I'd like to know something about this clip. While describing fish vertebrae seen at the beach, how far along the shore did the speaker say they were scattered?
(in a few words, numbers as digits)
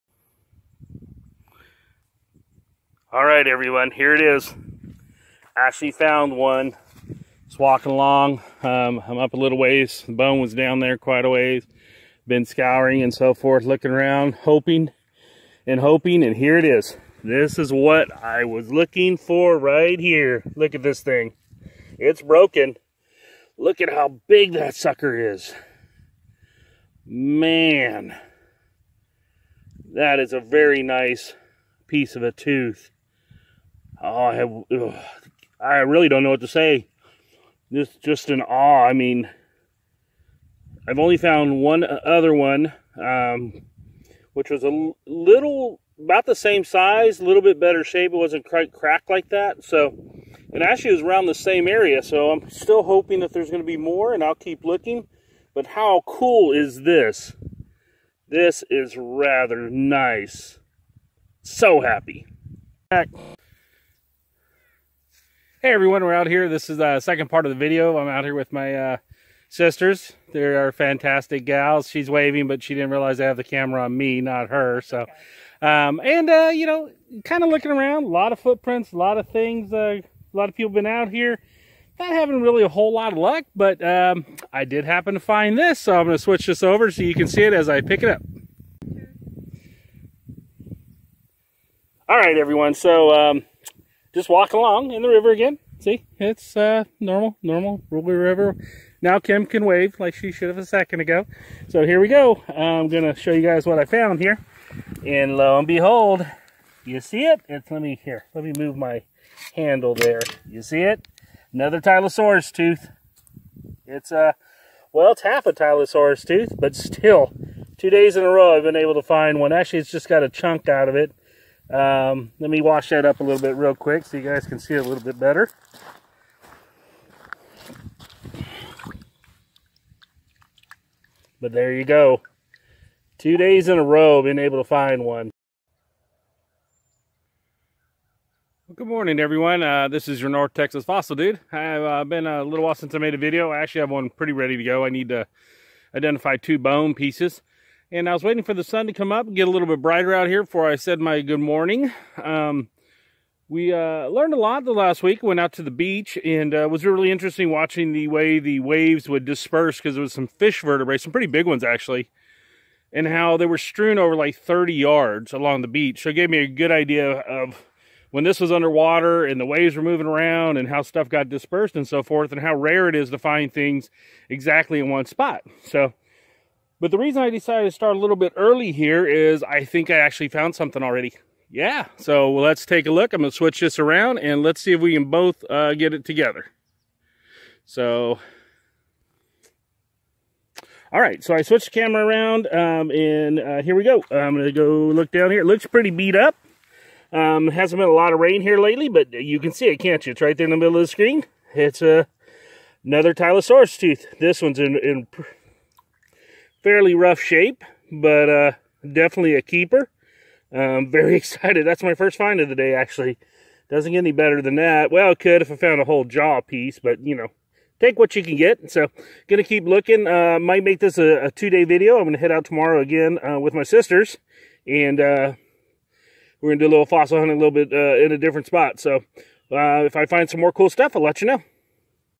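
30 yards.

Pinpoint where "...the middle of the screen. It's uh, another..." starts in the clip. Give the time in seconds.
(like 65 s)
200 s.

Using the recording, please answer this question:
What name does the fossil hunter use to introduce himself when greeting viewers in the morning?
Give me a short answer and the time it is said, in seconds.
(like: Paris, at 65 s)
North Texas Fossil Dude, at 140 s.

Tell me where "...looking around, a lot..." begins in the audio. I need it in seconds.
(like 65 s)
77 s.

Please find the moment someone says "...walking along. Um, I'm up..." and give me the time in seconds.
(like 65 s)
7 s.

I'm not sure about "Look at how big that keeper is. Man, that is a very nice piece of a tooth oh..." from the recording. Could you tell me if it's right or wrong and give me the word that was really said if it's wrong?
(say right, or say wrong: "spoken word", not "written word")
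wrong: "sucker", not "keeper".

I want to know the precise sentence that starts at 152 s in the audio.
Um, we uh, learned a lot the last week.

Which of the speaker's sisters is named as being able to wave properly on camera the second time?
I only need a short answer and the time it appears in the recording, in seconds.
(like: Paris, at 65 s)
Kim, at 99 s.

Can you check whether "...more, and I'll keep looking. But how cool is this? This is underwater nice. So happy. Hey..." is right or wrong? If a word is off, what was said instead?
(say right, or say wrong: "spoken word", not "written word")
wrong: "rather", not "underwater".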